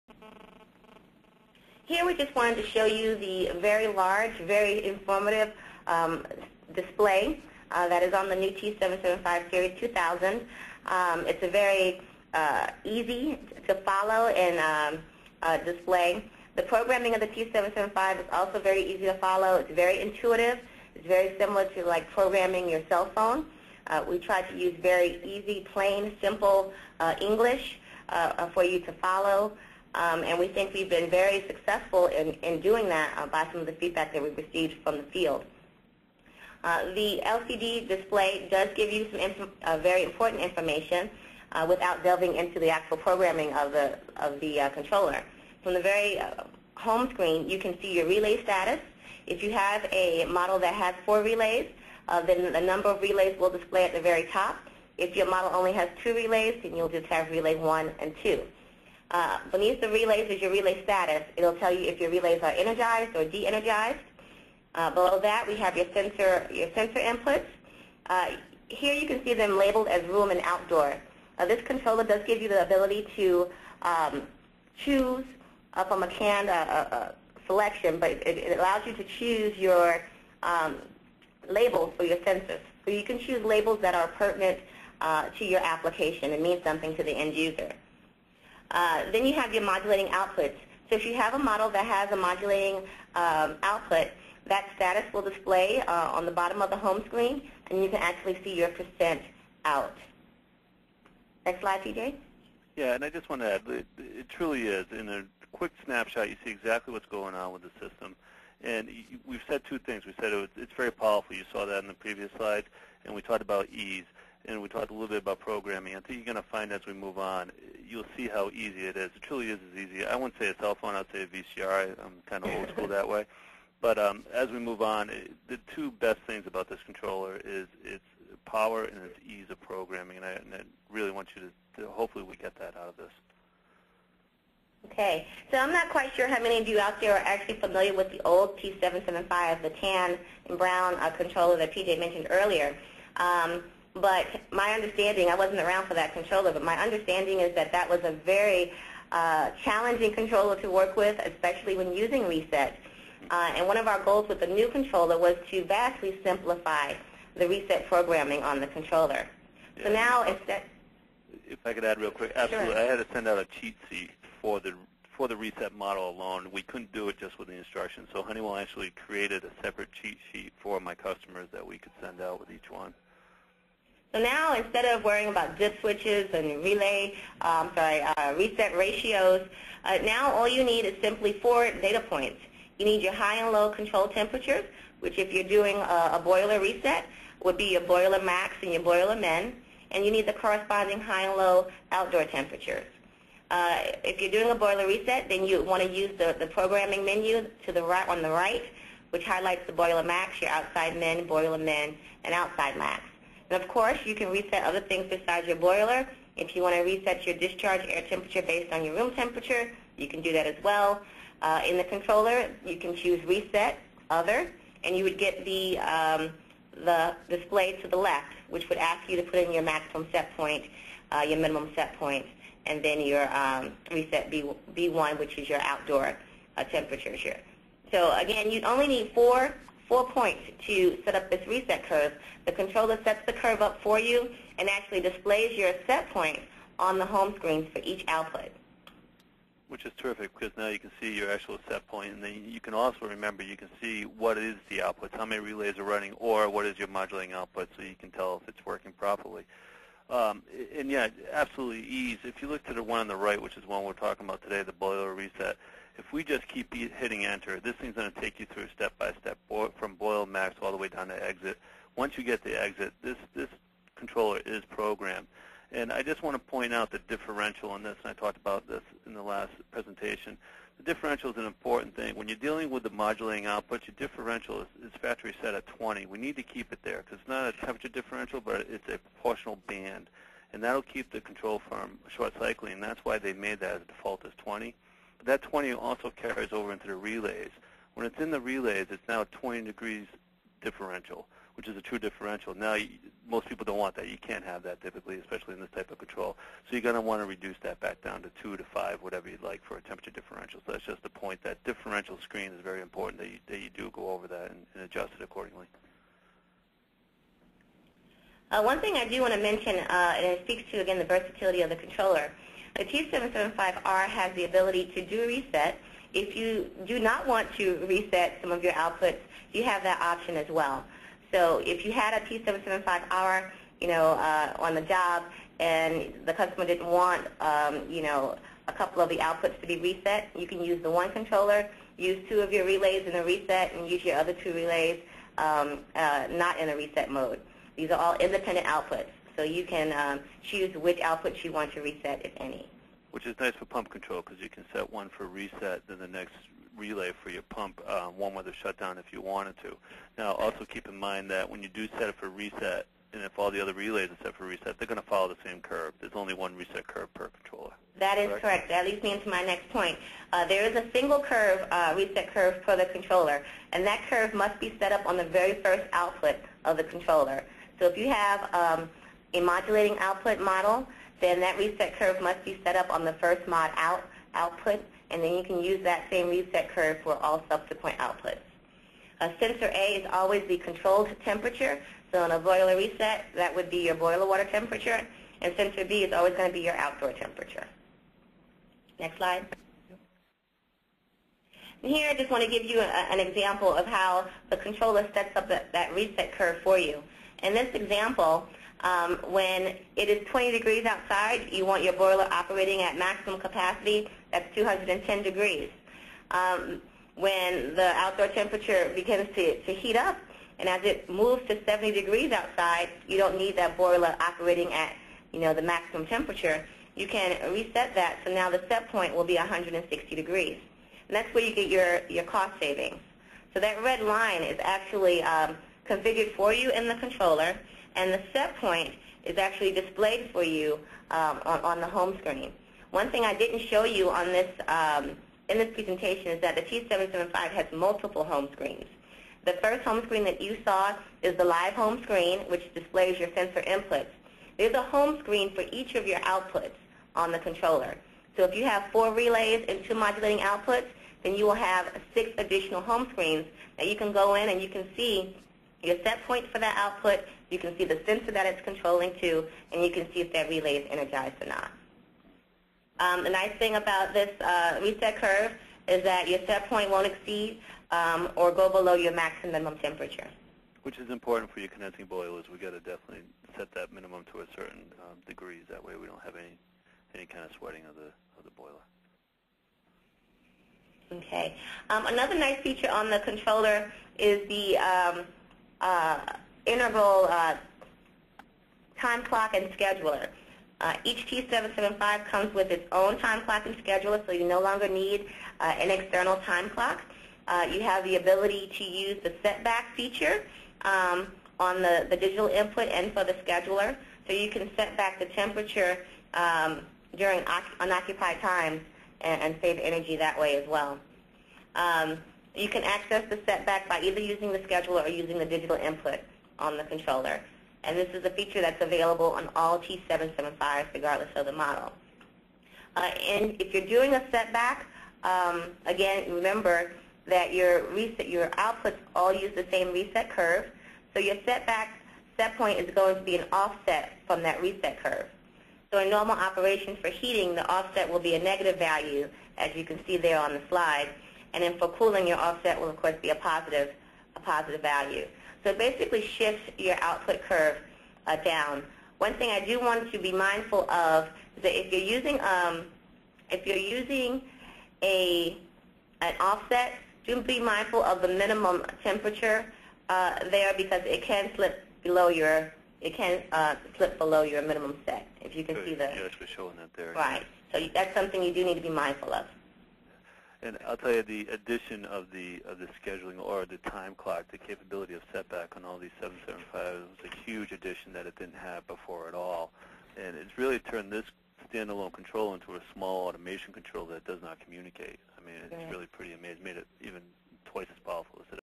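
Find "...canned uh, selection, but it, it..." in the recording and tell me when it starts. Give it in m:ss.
1:16.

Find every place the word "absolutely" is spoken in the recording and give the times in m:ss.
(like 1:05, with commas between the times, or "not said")
2:42, 4:11.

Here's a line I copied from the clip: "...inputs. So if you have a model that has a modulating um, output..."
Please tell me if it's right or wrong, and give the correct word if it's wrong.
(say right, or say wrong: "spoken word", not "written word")
wrong: "outputs", not "inputs".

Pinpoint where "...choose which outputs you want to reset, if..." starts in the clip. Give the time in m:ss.
5:40.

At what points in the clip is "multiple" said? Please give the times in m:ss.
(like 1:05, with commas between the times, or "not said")
7:17.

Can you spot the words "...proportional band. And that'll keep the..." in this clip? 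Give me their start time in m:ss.
4:38.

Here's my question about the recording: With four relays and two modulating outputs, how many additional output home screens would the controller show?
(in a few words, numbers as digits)
6.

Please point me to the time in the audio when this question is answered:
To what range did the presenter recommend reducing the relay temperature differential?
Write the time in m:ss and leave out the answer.
4:58.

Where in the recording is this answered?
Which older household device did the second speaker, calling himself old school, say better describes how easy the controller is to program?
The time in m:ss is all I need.
2:01.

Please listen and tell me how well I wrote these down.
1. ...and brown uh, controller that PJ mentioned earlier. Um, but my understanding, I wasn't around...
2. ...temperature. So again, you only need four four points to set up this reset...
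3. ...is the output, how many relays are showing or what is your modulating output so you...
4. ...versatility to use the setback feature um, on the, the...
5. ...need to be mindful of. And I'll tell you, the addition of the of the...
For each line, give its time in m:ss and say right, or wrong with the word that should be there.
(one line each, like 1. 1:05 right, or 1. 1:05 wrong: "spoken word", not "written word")
1. 2:20 right
2. 3:46 right
3. 4:04 wrong: "running", not "showing"
4. 8:18 wrong: "ability", not "versatility"
5. 9:28 right.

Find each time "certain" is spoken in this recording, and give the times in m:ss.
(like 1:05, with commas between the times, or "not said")
7:54.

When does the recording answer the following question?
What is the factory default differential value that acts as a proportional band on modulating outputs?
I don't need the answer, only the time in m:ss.
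4:35.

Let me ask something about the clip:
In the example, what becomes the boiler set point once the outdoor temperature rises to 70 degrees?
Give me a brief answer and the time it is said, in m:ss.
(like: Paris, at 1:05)
160 degrees, at 6:59.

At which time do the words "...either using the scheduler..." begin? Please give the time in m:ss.
8:34.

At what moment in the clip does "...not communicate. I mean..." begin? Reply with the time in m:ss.
9:44.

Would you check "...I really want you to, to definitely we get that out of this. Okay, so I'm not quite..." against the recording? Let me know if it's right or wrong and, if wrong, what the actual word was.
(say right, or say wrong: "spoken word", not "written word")
wrong: "hopefully", not "definitely".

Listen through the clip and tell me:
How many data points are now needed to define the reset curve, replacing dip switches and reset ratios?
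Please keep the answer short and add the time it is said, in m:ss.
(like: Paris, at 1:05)
4, at 3:01.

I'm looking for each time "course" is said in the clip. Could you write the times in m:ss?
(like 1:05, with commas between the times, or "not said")
3:23, 9:03.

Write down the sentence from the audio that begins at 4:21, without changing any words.
Once you get the exit, this, this controller is programmed.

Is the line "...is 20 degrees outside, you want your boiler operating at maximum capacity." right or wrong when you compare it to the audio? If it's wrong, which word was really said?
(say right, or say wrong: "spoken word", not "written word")
right.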